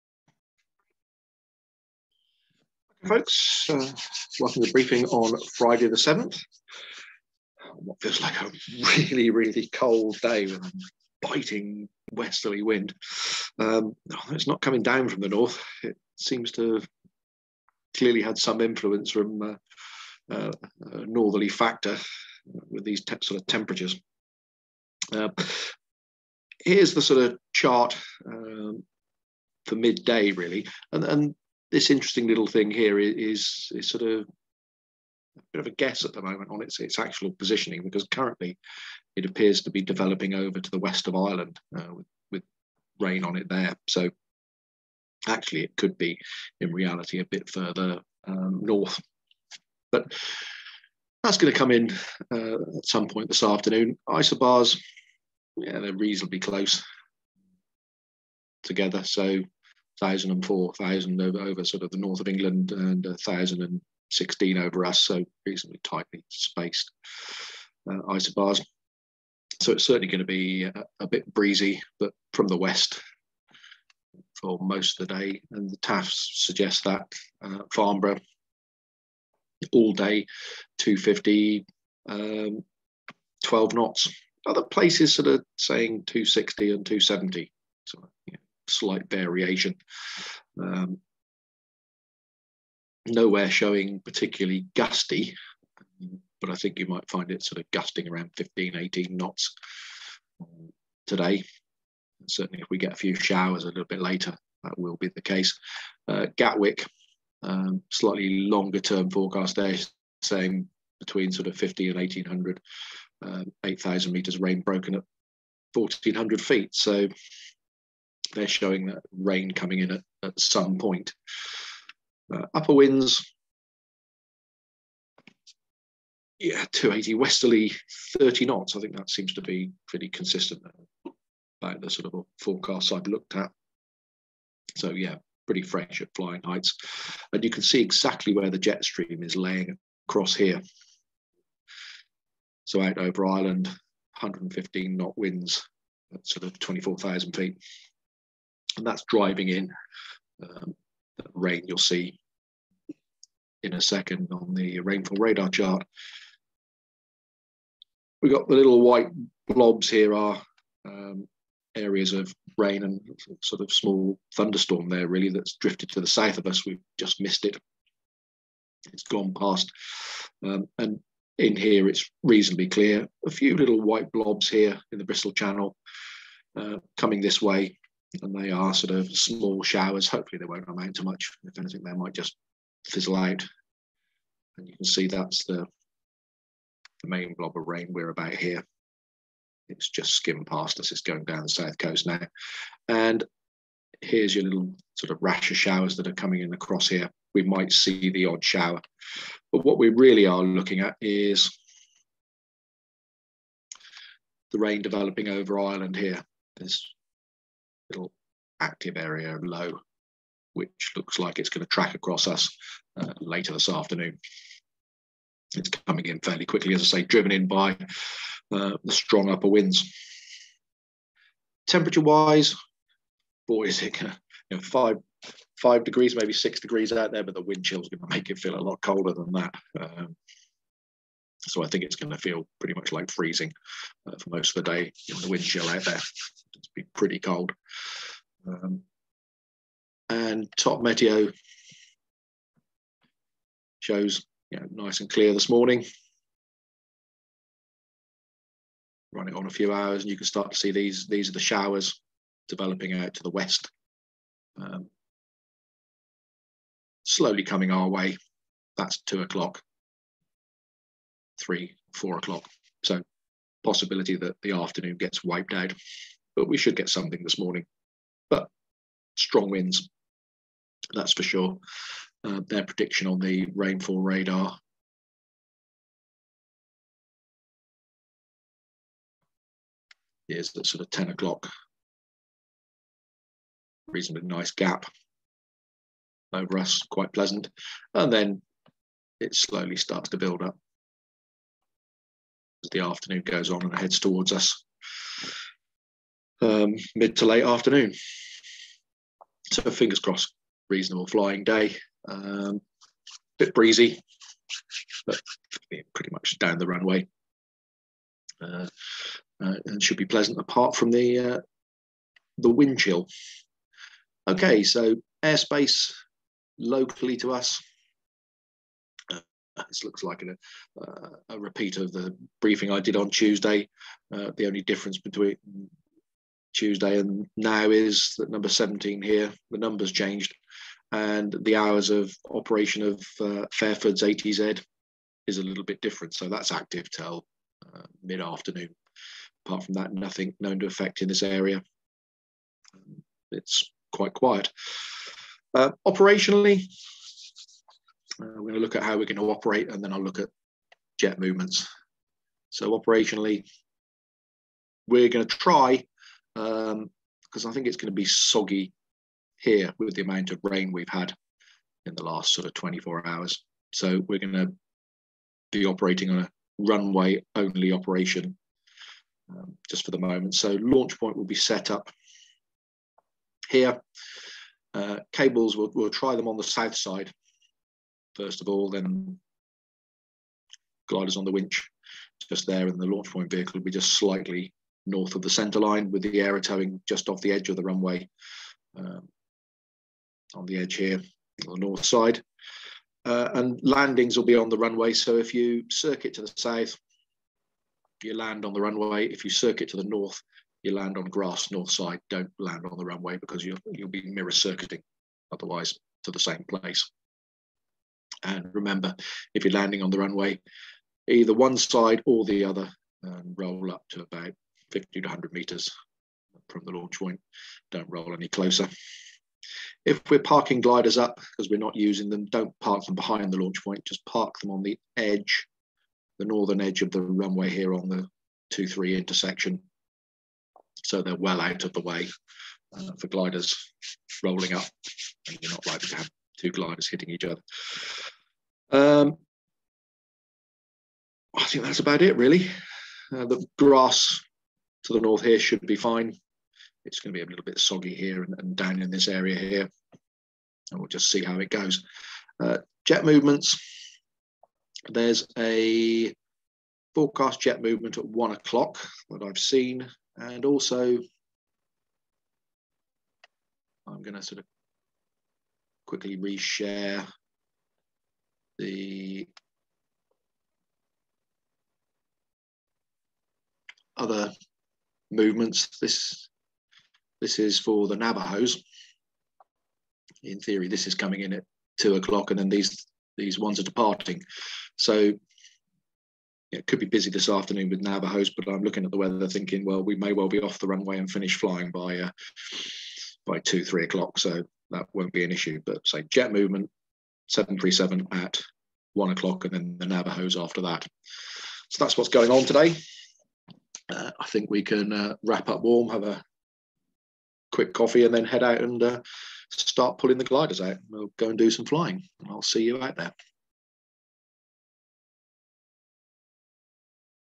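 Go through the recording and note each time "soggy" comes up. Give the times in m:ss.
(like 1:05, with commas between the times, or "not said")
5:58, 7:27.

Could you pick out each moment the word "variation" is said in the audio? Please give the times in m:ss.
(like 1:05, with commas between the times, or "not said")
1:29.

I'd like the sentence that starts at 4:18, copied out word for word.
That's two o'clock, three, four o'clock.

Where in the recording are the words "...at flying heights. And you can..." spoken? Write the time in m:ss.
2:16.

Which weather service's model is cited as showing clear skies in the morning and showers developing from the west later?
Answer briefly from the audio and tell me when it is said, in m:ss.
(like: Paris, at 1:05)
top meteo, at 4:00.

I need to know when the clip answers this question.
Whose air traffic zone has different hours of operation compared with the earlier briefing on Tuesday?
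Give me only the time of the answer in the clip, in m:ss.
5:33.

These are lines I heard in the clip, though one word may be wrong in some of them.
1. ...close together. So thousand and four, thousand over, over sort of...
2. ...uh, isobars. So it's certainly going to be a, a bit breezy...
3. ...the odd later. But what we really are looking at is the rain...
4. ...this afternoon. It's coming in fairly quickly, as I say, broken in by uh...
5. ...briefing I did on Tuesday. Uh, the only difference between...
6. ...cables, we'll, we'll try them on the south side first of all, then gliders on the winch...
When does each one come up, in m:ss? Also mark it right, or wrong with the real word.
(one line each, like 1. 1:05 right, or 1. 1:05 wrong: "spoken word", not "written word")
1. 0:56 right
2. 1:07 right
3. 3:18 wrong: "shower", not "later"
4. 3:33 wrong: "driven", not "broken"
5. 5:22 right
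6. 6:15 right.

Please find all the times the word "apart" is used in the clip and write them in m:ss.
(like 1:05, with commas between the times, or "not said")
5:10, 5:39.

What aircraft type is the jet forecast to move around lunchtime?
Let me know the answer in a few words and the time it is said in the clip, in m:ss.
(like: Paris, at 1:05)
737, at 8:17.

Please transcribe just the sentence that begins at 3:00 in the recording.
Hopefully, they won't amount to much.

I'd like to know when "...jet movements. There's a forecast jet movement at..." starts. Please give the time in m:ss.
7:32.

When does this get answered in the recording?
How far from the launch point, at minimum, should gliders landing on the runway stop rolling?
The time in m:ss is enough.
6:54.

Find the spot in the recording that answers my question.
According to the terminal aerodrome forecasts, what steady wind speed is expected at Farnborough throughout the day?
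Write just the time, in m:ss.
1:23.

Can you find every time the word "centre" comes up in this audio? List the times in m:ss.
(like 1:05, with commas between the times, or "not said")
6:25.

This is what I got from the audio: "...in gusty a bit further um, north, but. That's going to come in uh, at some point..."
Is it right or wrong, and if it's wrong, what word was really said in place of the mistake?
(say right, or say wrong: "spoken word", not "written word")
wrong: "reality", not "gusty".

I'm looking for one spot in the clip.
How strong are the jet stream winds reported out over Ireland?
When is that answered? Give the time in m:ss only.
2:23.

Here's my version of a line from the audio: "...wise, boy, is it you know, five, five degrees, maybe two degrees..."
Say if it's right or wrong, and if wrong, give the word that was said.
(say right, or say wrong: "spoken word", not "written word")
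wrong: "six", not "two".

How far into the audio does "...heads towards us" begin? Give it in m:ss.
4:53.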